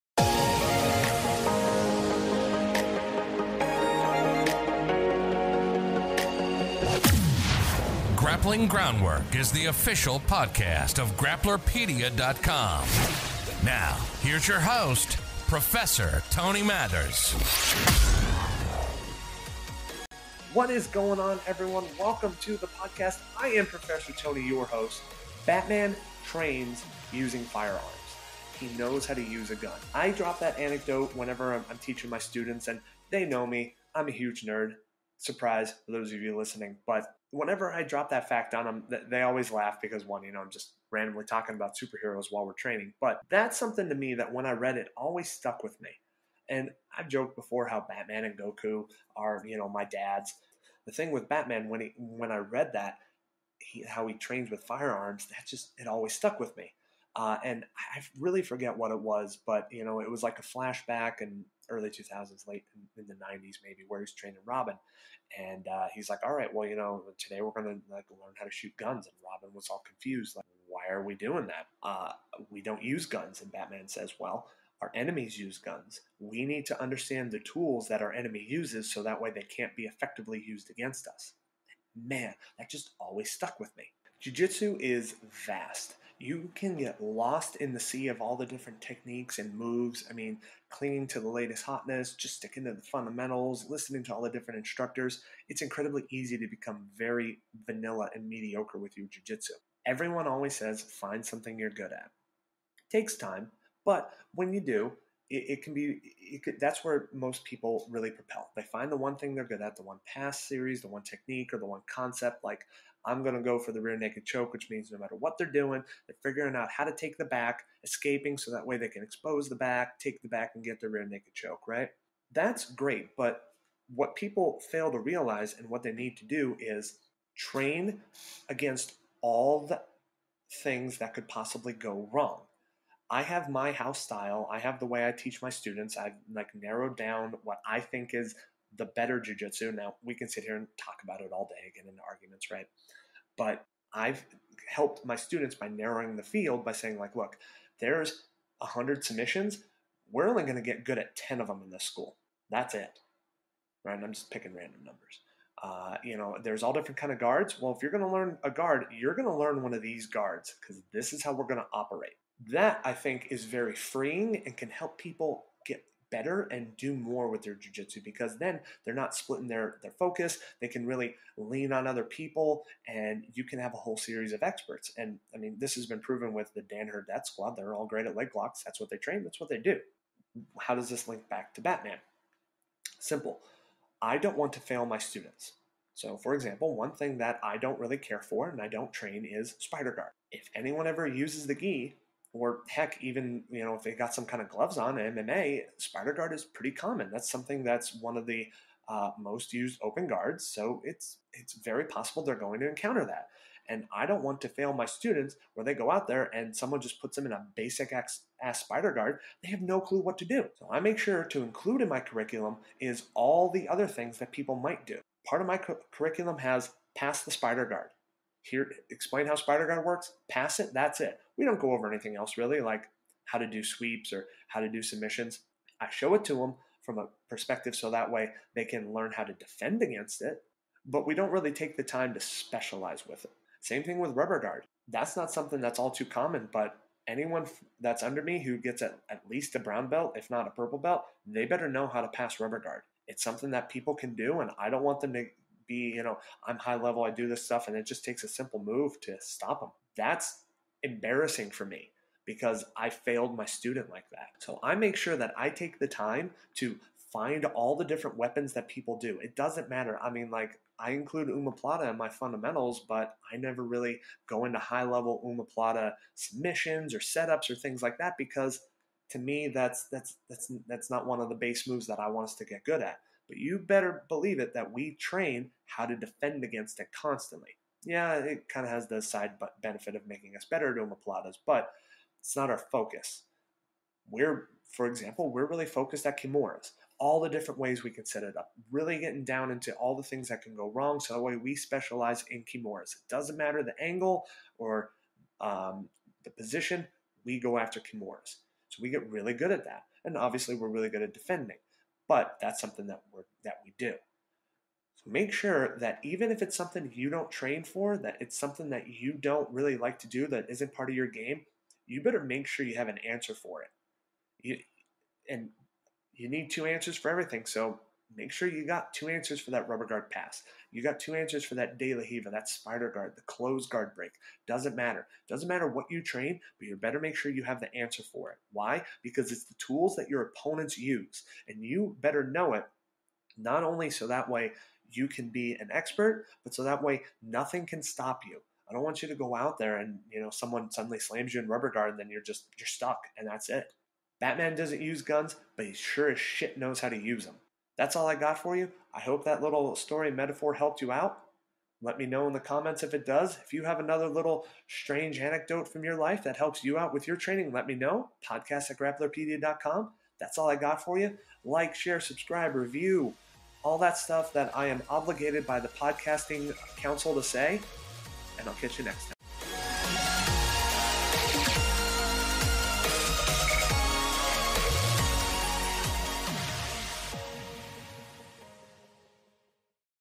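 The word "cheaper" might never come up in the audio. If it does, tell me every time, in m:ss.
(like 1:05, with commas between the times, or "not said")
not said.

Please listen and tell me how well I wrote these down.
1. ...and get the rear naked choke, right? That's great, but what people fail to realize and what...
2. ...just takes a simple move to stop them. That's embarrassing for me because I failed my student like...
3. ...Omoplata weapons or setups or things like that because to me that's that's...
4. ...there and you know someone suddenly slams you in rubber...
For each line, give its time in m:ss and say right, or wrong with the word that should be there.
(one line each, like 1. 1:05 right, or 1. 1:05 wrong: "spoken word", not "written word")
1. 2:00 right
2. 4:07 right
3. 4:25 wrong: "submissions", not "weapons"
4. 5:39 right.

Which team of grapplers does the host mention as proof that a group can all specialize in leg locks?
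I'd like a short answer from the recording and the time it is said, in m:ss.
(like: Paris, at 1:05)
Danaher Squad, at 2:56.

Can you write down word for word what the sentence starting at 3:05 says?
So, for example, one thing that I don't really care for and I don't train is spider guard.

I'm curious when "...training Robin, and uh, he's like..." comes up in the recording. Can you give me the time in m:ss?
1:04.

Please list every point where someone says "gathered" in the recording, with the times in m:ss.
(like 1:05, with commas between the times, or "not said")
not said.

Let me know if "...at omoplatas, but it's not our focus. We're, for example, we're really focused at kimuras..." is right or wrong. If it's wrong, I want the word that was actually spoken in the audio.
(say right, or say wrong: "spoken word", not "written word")
right.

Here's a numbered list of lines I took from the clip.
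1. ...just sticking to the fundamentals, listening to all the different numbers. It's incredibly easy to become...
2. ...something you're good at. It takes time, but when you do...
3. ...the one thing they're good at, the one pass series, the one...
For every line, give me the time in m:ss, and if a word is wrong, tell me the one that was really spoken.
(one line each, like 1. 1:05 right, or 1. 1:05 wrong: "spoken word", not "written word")
1. 1:32 wrong: "instructors", not "numbers"
2. 1:41 right
3. 1:48 right.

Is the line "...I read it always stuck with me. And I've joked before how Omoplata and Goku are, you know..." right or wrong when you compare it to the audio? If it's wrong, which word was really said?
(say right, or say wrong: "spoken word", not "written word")
wrong: "Batman", not "Omoplata".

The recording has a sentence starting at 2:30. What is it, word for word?
We're only going to get good at ten of them in this school.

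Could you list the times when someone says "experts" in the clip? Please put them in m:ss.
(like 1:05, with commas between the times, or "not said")
2:54, 5:35.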